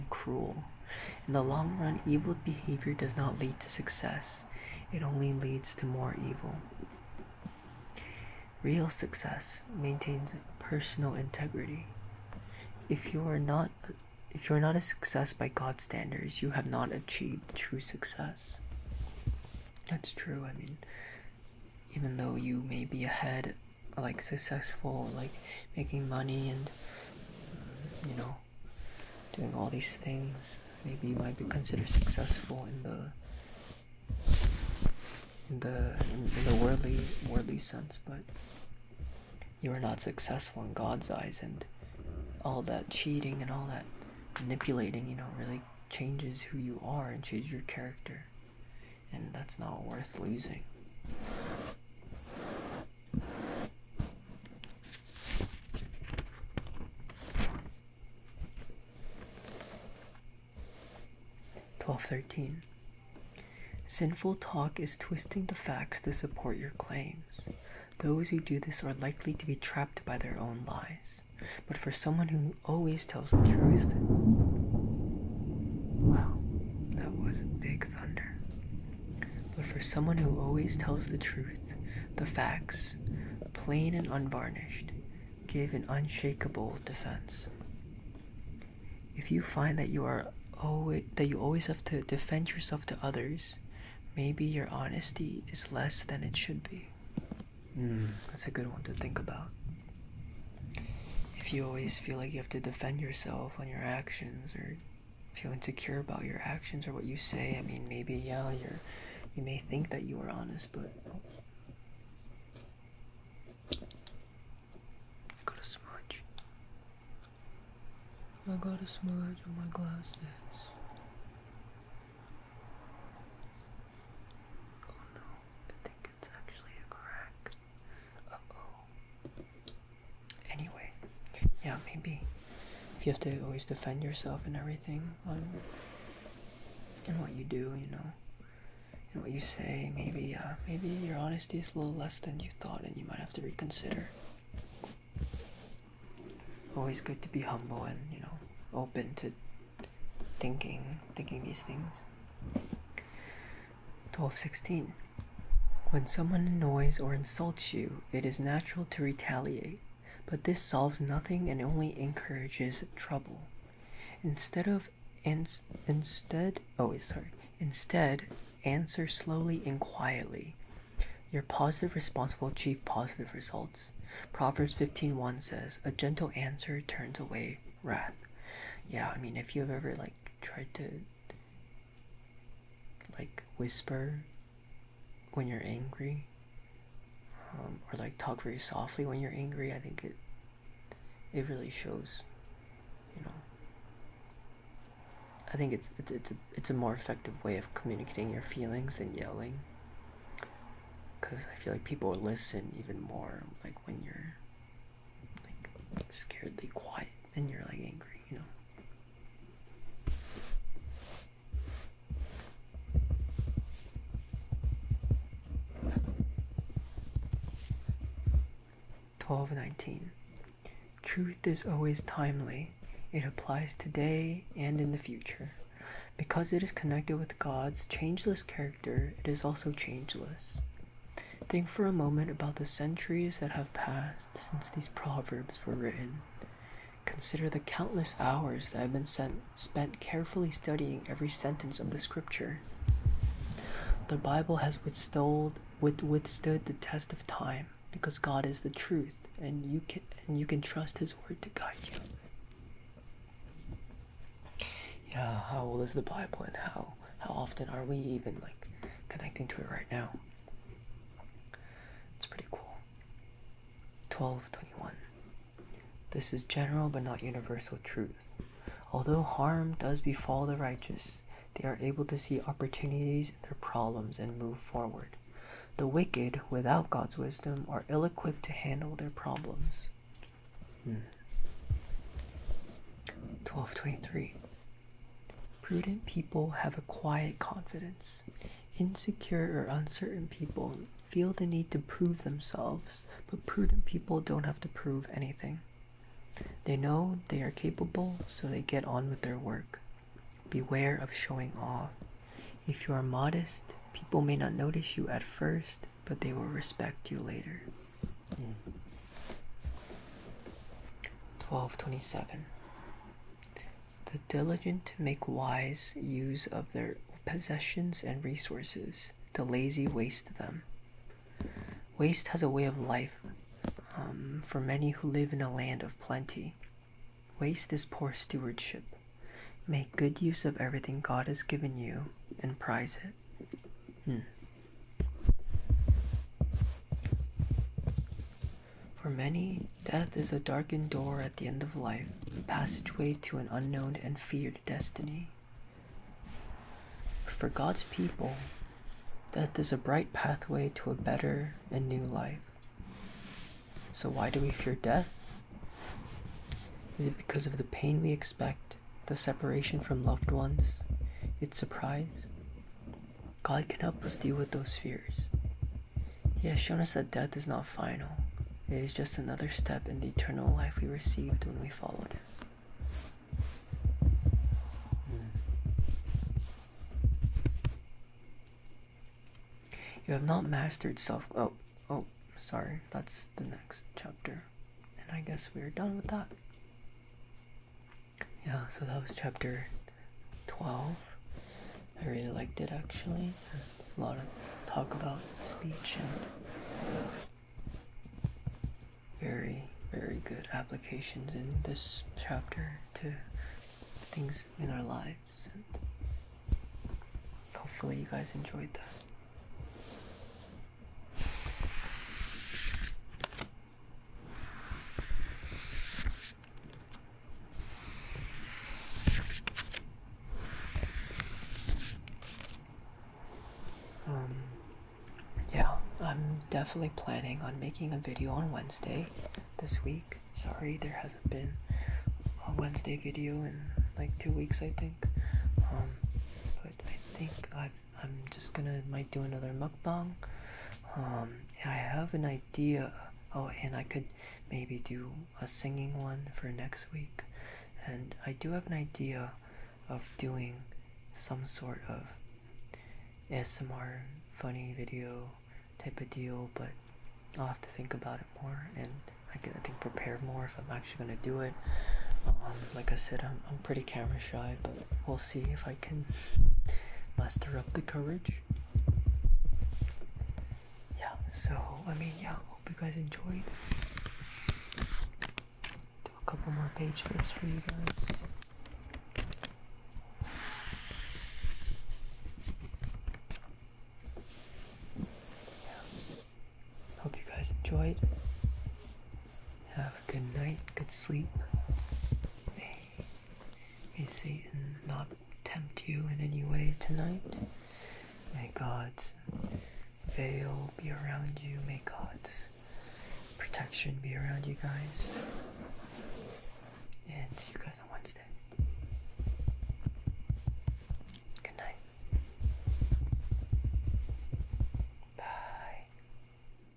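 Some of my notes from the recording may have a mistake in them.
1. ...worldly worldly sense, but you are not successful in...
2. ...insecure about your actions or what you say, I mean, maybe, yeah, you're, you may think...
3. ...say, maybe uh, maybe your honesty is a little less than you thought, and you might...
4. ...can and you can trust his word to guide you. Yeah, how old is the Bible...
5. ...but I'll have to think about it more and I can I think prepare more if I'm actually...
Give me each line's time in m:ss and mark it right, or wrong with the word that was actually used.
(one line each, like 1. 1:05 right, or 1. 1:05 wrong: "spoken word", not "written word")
1. 0:36 right
2. 1:45 right
3. 2:19 right
4. 4:09 right
5. 7:36 right.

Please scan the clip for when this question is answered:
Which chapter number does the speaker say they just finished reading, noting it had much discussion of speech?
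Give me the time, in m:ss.
6:29.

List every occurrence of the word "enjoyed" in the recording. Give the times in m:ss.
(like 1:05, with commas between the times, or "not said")
6:48, 7:52, 8:07.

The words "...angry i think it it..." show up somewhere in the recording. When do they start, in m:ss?
3:09.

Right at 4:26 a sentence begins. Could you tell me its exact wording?
This is general but not universal truth.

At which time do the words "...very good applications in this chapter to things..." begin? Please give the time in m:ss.
6:39.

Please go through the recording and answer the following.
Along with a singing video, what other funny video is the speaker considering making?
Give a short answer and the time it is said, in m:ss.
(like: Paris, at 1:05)
ASMR, at 7:33.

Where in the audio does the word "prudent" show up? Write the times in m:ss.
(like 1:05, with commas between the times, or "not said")
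4:45, 4:53.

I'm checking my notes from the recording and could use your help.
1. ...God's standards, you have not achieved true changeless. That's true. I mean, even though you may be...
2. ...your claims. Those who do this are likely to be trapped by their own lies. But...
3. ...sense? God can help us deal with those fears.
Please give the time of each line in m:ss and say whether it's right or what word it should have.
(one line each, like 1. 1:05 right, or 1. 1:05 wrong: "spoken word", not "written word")
1. 0:15 wrong: "success", not "changeless"
2. 1:06 right
3. 6:01 wrong: "surprise", not "sense".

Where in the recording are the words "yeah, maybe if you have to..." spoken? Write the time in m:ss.
2:11.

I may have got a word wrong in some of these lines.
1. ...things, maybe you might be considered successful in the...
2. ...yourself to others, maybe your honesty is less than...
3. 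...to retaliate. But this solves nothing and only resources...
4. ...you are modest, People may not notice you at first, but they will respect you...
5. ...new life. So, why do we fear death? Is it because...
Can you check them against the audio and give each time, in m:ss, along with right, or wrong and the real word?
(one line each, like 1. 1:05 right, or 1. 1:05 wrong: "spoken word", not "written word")
1. 0:29 right
2. 1:32 right
3. 2:38 wrong: "encourages", not "resources"
4. 5:02 right
5. 5:51 right.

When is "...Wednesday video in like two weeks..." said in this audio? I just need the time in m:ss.
7:12.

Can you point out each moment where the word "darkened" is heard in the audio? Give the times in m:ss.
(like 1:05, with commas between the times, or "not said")
5:40.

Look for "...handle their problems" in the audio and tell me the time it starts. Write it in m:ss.
4:38.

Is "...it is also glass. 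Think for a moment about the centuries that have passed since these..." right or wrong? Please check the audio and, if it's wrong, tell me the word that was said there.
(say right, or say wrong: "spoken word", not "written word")
wrong: "changeless", not "glass".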